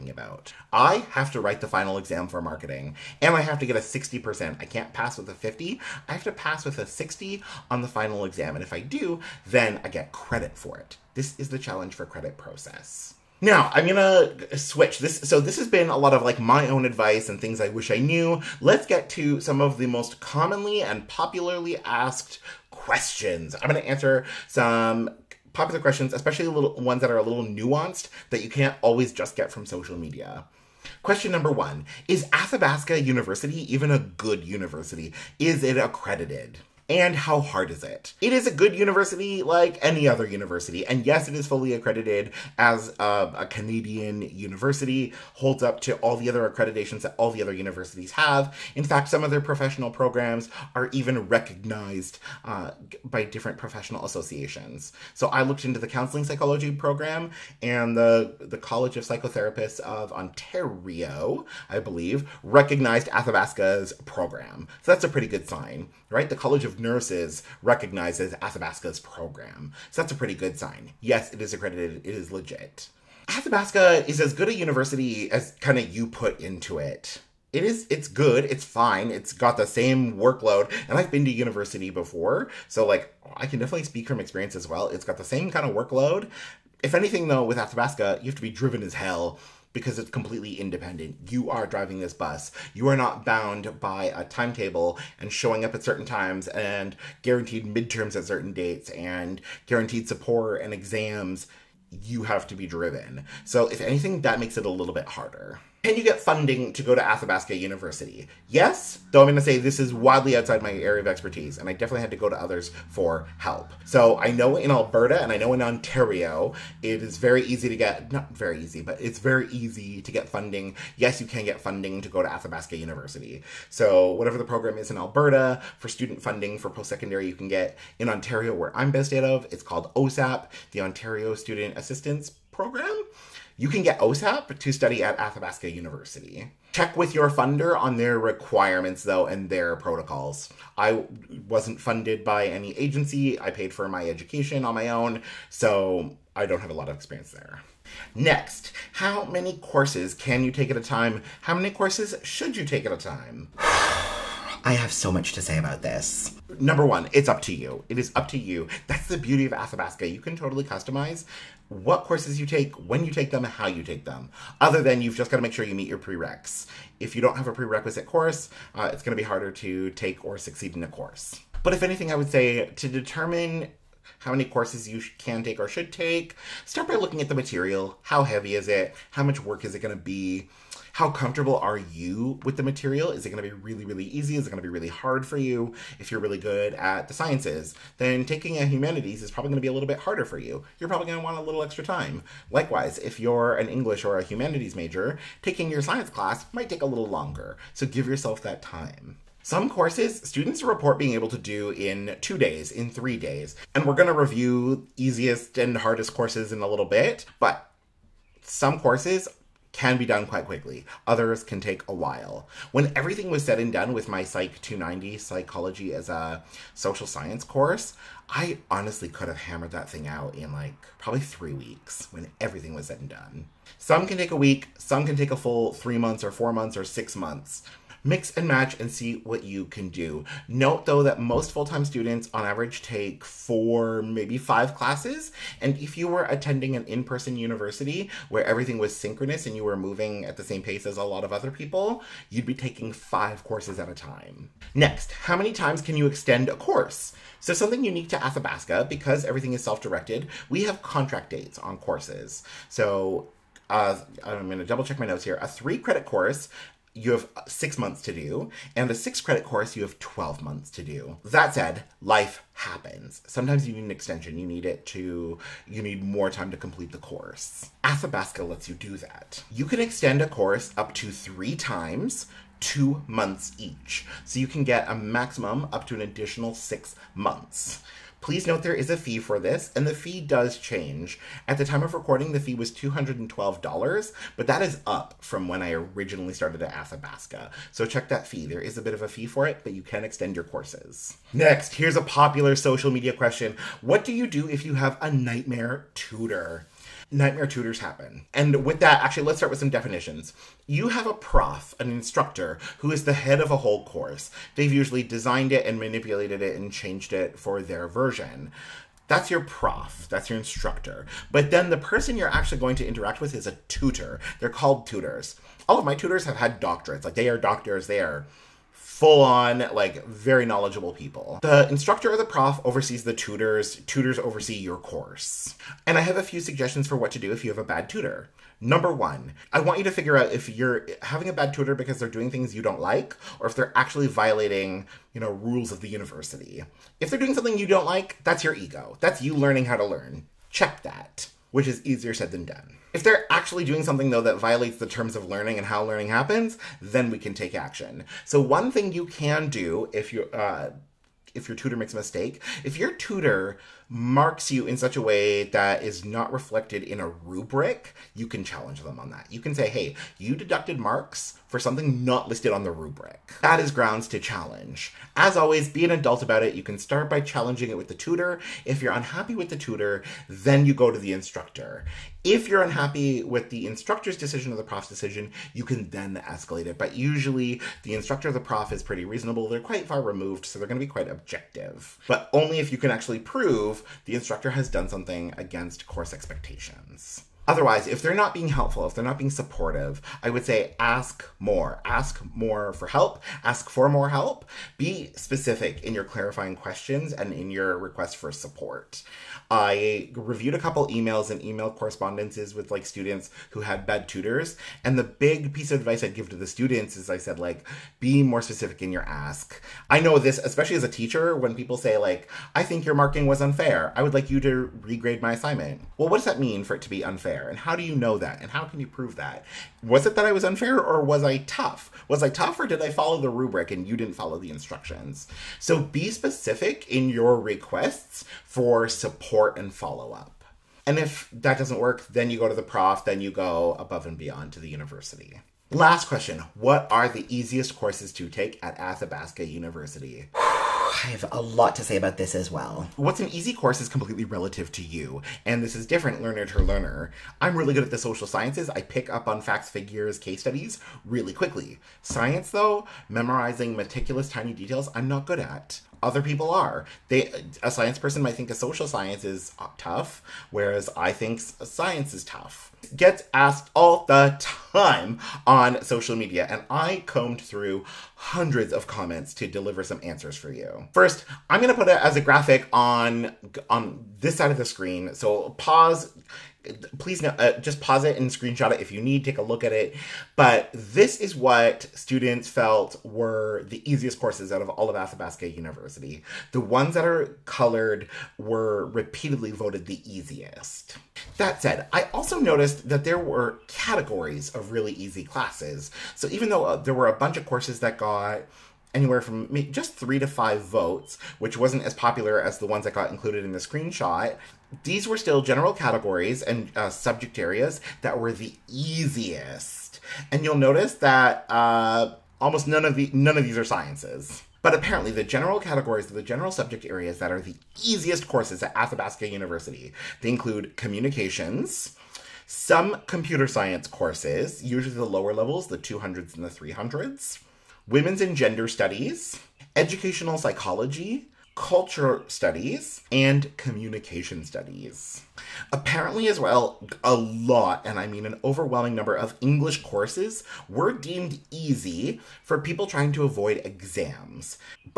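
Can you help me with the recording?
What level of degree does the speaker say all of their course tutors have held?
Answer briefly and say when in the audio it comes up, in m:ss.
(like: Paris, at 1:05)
Doctorates, at 5:16.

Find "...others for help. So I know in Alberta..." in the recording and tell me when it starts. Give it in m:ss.
1:52.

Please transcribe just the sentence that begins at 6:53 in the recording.
I would like you to regrade my assignment.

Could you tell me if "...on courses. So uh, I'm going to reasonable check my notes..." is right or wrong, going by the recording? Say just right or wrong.
wrong.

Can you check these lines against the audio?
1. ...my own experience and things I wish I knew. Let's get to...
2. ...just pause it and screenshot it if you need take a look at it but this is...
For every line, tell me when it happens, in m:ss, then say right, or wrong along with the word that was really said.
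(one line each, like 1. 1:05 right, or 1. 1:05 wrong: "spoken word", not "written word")
1. 0:16 wrong: "advice", not "experience"
2. 7:57 right.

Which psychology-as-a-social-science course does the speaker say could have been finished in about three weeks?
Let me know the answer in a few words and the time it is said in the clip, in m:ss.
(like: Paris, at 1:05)
Psych 290, at 3:34.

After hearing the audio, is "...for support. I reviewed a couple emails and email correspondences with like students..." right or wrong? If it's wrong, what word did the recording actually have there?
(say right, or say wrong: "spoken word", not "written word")
right.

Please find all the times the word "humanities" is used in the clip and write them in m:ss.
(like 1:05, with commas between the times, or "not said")
3:08, 3:14.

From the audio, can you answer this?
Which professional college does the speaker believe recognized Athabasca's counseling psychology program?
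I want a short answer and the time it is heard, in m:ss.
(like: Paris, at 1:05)
College of Psychotherapists of Ontario, at 0:58.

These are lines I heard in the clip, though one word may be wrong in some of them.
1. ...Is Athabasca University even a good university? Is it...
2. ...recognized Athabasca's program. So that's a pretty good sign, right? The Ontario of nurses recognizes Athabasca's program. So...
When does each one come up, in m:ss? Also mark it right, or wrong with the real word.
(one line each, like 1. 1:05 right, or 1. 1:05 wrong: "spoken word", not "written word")
1. 0:32 right
2. 1:02 wrong: "College", not "Ontario".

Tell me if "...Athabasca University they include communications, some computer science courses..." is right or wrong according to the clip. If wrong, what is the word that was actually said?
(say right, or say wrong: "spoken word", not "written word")
right.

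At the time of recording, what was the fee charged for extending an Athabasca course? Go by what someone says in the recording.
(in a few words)
$212.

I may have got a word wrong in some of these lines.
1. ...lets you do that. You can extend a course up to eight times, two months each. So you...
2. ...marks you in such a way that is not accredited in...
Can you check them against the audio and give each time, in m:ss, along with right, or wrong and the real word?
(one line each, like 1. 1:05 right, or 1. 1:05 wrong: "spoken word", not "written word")
1. 4:28 wrong: "three", not "eight"
2. 5:53 wrong: "reflected", not "accredited".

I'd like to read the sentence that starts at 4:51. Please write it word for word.
Next, here's a popular social media question What do you do if you have a nightmare tutor?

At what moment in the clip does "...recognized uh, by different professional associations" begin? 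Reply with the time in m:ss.
0:51.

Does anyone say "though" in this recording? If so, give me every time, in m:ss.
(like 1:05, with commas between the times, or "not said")
1:27, 1:49, 2:19, 3:50, 5:44, 7:32, 8:16.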